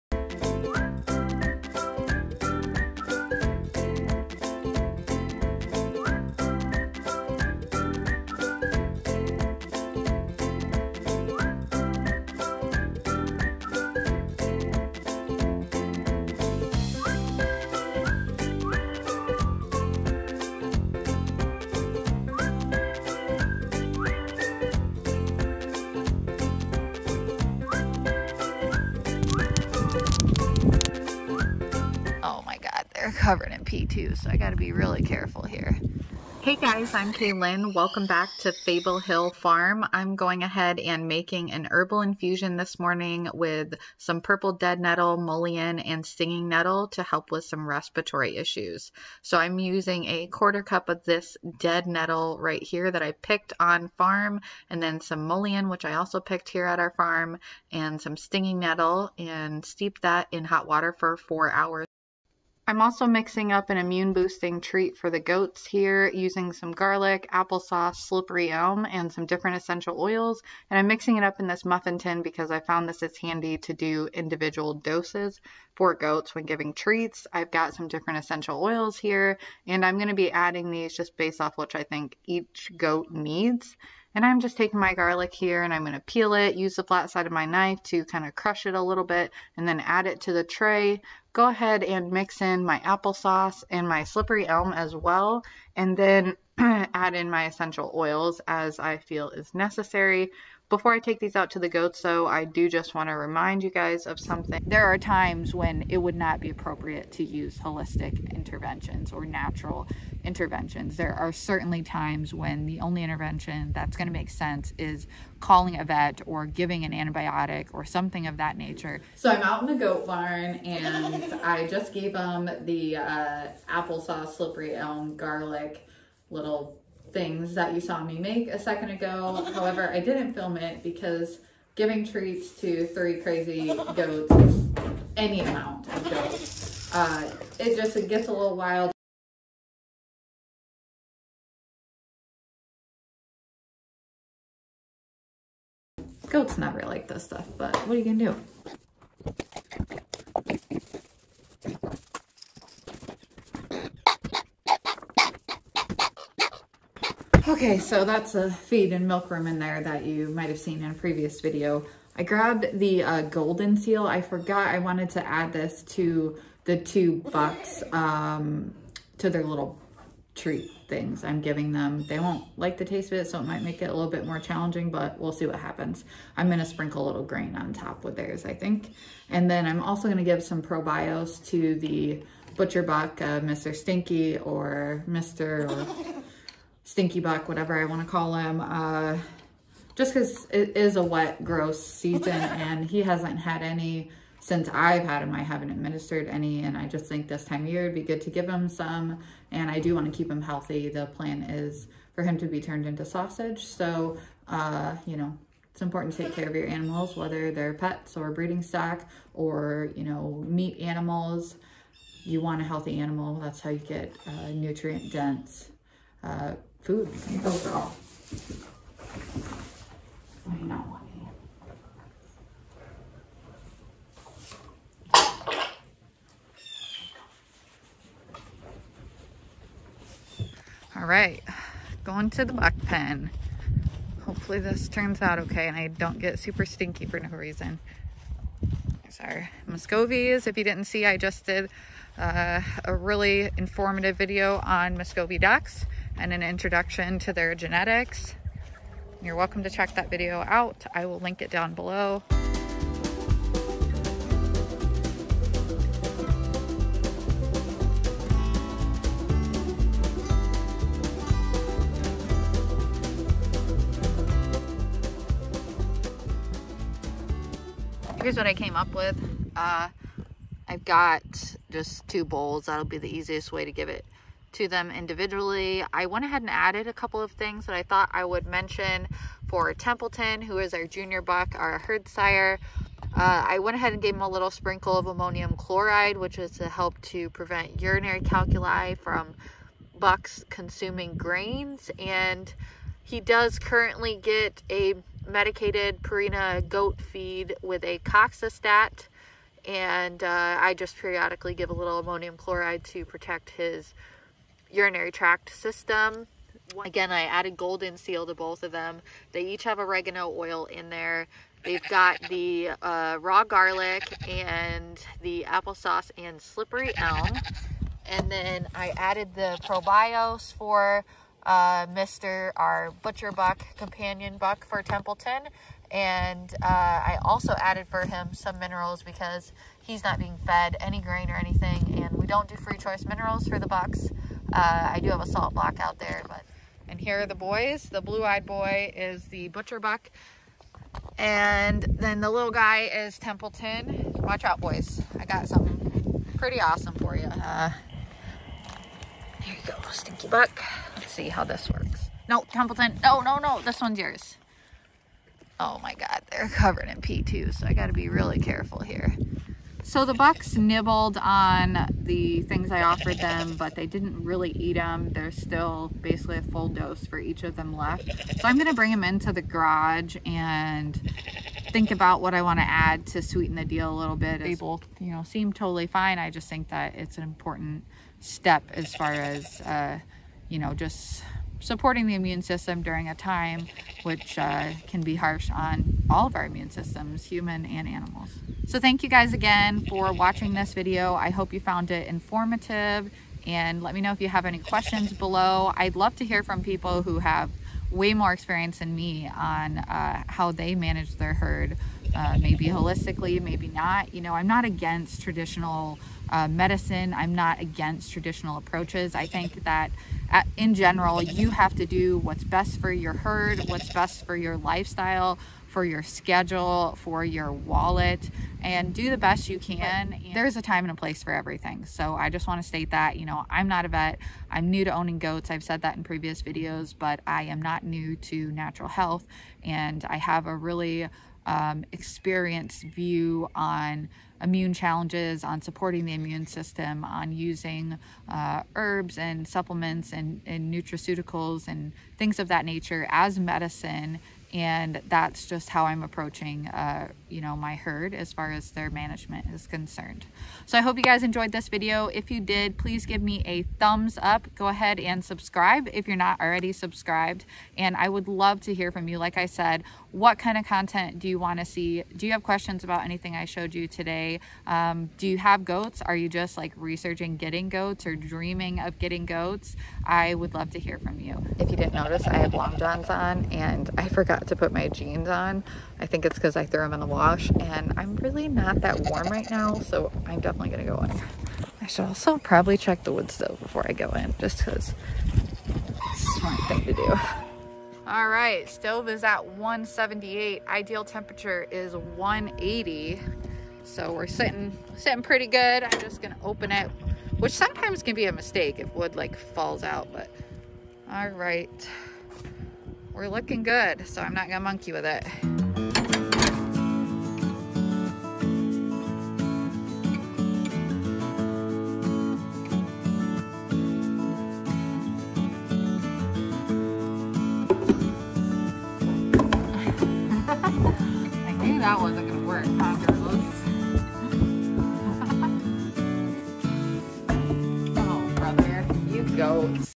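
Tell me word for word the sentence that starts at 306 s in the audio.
Again, I added golden seal to both of them.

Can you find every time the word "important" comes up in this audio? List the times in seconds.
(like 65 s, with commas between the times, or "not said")
205 s, 377 s.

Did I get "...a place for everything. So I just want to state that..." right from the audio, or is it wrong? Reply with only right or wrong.
right.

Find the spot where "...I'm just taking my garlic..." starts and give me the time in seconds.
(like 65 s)
84 s.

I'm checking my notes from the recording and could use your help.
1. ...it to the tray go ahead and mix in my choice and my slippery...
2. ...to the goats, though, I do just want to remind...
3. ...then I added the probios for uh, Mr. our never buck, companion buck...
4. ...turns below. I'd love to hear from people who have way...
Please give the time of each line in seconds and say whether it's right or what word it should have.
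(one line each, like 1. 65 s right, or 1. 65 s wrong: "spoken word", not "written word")
1. 90 s wrong: "applesauce", not "choice"
2. 101 s right
3. 318 s wrong: "butcher", not "never"
4. 394 s wrong: "questions", not "turns".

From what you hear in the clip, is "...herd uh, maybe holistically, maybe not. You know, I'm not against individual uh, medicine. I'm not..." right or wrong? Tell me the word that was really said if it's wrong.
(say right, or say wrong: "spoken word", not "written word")
wrong: "traditional", not "individual".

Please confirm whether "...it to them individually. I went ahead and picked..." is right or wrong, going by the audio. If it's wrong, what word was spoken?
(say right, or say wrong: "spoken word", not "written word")
wrong: "added", not "picked".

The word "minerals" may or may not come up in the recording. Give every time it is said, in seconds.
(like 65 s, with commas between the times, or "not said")
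328 s, 333 s.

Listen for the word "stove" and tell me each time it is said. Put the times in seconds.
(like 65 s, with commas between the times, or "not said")
483 s, 488 s.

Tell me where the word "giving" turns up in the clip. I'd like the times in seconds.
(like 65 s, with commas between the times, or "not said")
76 s, 116 s, 131 s, 171 s.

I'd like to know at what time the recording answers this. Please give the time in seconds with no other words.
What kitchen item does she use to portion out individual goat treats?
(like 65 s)
71 s.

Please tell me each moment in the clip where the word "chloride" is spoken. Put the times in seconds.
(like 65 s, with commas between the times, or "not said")
285 s, 302 s.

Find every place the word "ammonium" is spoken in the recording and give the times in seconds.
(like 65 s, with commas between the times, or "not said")
285 s, 301 s.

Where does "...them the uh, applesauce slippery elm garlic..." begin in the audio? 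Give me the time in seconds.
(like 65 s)
122 s.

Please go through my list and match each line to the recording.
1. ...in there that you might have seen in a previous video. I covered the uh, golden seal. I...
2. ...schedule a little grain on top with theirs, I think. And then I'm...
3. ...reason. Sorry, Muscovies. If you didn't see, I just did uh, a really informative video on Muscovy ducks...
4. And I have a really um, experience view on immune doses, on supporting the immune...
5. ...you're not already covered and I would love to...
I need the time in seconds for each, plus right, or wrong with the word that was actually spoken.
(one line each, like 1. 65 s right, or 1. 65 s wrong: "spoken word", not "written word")
1. 159 s wrong: "grabbed", not "covered"
2. 176 s wrong: "sprinkle", not "schedule"
3. 237 s right
4. 429 s wrong: "challenges", not "doses"
5. 456 s wrong: "subscribed", not "covered".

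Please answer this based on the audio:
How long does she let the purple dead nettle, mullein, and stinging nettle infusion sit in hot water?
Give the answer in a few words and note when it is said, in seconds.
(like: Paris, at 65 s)
4 hours, at 61 s.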